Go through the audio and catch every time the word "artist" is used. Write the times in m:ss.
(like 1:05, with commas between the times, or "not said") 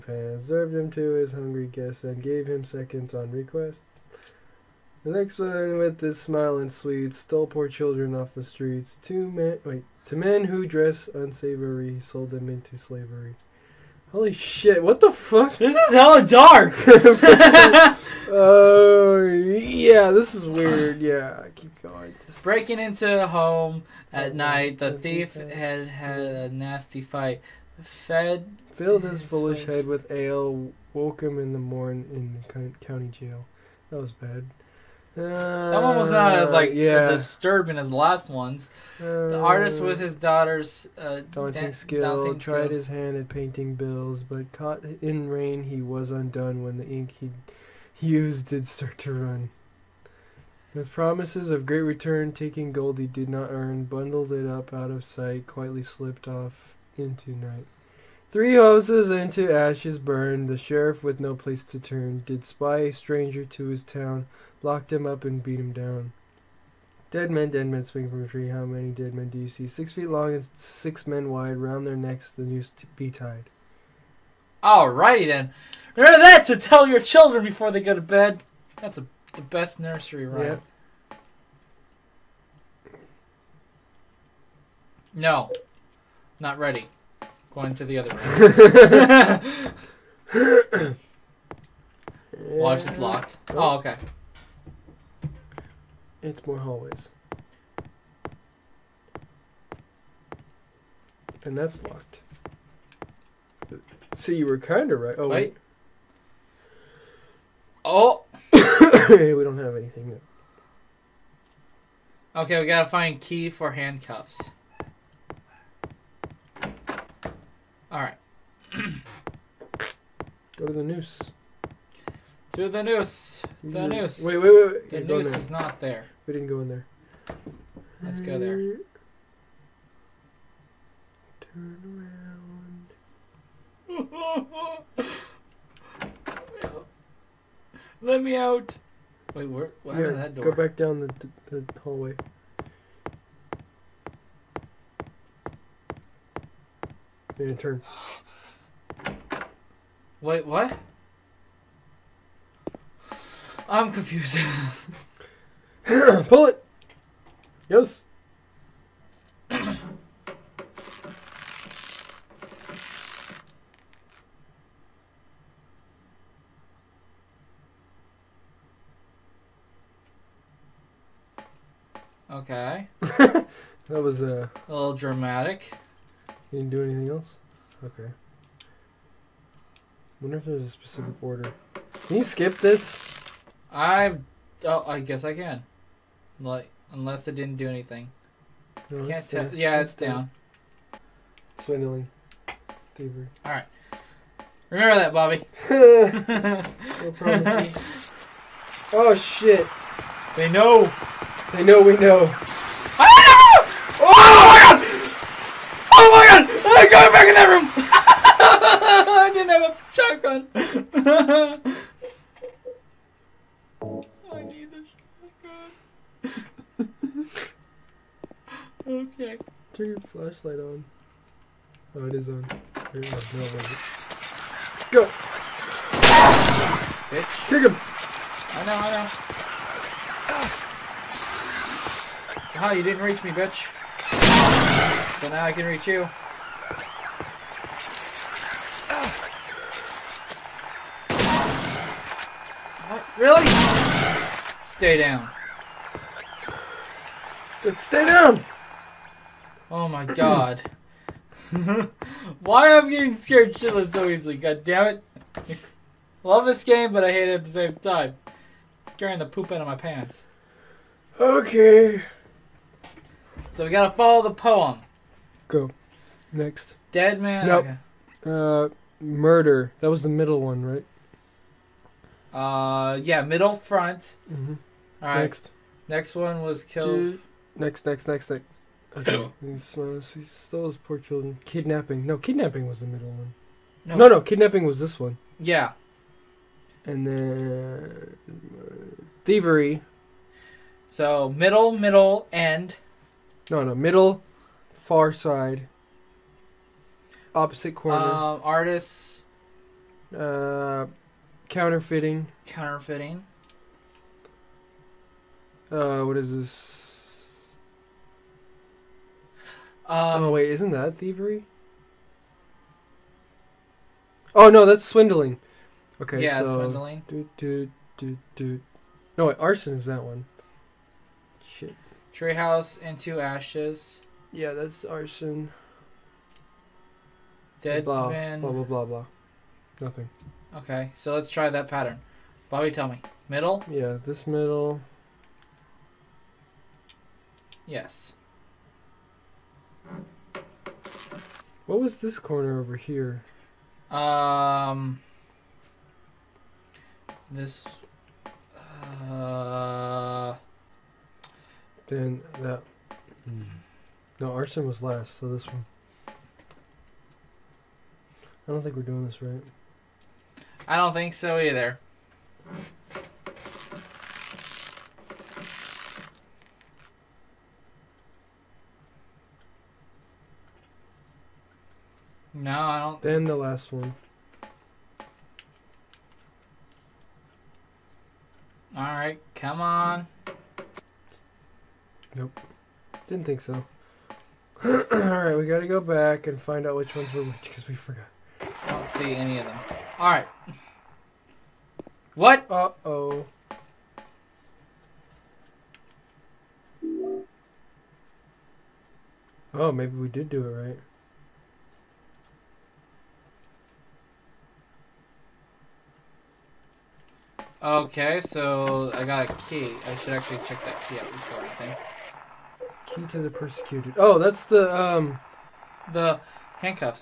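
0:39, 4:58.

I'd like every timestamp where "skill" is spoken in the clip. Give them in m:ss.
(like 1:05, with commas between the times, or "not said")
0:41.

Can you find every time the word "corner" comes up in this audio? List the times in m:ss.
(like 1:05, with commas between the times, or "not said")
4:57, 5:42.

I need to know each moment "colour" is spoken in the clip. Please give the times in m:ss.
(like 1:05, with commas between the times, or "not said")
not said.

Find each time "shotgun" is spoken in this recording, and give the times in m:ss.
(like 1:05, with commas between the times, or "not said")
3:29, 3:36.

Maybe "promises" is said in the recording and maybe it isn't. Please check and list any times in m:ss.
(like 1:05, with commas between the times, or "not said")
0:50, 3:17.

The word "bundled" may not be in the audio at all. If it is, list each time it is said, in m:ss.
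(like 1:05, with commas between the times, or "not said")
0:53.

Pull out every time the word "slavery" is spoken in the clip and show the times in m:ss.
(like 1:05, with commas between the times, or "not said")
0:12.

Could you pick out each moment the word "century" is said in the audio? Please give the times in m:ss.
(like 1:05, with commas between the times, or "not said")
not said.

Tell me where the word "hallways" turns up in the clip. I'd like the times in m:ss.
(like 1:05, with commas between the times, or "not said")
1:36, 2:21.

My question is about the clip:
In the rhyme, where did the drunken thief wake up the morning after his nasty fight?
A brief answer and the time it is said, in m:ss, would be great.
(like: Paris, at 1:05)
county jail, at 0:32.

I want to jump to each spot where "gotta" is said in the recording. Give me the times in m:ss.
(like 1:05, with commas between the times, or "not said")
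1:52, 4:23.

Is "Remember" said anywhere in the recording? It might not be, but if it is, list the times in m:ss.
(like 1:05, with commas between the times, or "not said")
1:15, 3:14.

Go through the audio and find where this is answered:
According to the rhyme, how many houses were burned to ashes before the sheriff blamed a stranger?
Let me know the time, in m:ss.
0:58.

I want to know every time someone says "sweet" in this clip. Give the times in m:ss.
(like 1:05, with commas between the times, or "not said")
0:06.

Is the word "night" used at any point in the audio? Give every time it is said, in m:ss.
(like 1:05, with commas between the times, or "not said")
0:24, 0:57.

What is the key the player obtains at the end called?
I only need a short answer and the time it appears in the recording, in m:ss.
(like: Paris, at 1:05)
Key to the persecuted, at 6:52.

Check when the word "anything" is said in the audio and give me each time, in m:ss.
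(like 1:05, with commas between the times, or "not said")
1:49, 2:56, 3:07, 6:51.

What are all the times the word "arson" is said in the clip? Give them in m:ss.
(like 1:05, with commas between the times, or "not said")
5:19, 5:24, 5:54.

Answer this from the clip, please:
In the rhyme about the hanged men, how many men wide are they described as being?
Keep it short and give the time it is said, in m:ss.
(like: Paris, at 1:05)
6, at 1:10.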